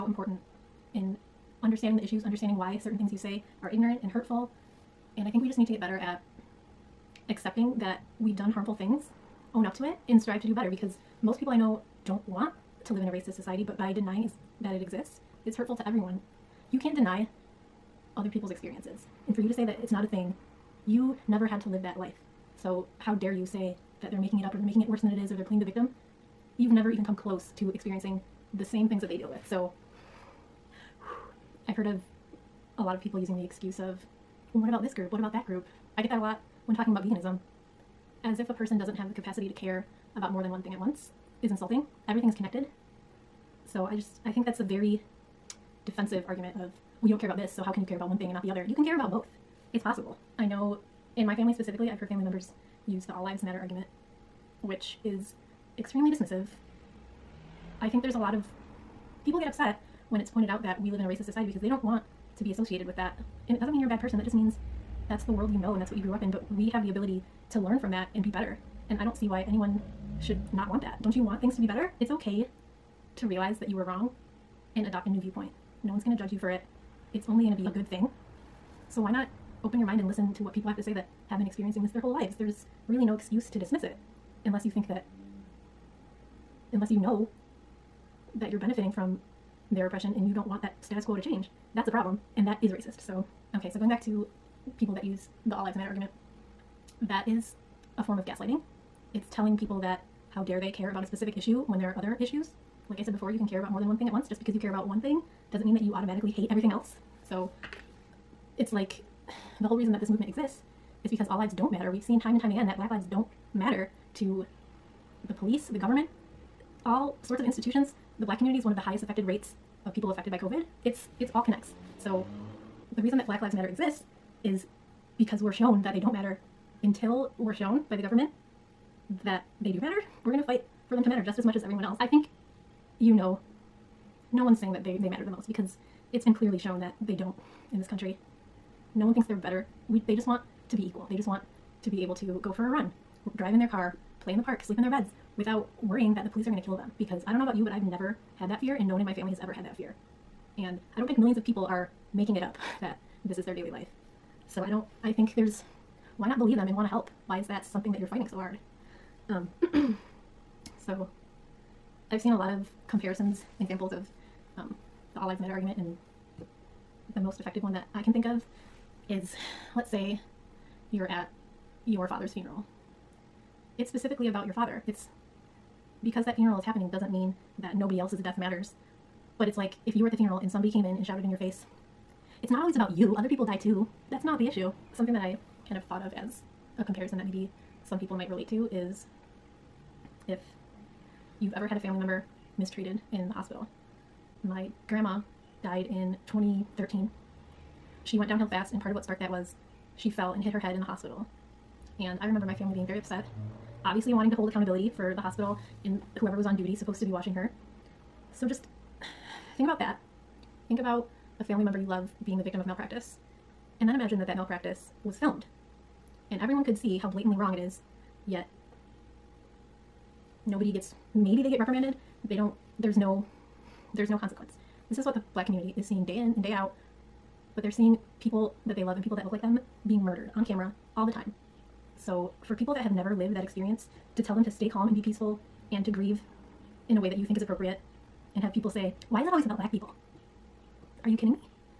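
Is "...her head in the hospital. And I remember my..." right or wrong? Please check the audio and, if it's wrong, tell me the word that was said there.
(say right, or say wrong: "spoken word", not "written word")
right.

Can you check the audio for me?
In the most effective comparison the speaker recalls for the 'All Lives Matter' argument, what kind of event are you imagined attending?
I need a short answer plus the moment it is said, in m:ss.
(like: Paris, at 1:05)
your father's funeral, at 2:51.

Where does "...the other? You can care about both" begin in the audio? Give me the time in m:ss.
0:48.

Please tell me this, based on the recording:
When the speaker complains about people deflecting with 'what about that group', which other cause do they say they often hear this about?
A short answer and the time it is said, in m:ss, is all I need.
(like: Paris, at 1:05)
veganism, at 0:37.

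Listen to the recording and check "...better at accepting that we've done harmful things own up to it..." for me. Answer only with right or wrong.
right.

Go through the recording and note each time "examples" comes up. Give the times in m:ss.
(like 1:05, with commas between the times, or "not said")
2:43.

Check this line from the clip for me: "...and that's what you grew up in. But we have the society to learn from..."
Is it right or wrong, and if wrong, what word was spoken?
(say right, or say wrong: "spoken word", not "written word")
wrong: "ability", not "society".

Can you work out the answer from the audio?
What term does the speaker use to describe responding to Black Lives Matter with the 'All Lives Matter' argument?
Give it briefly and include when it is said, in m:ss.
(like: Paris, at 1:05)
gaslighting, at 1:38.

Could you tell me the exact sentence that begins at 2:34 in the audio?
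So I don't I think there's why not believe them and want to help?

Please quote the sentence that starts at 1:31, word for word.
That's a problem, and that is racist.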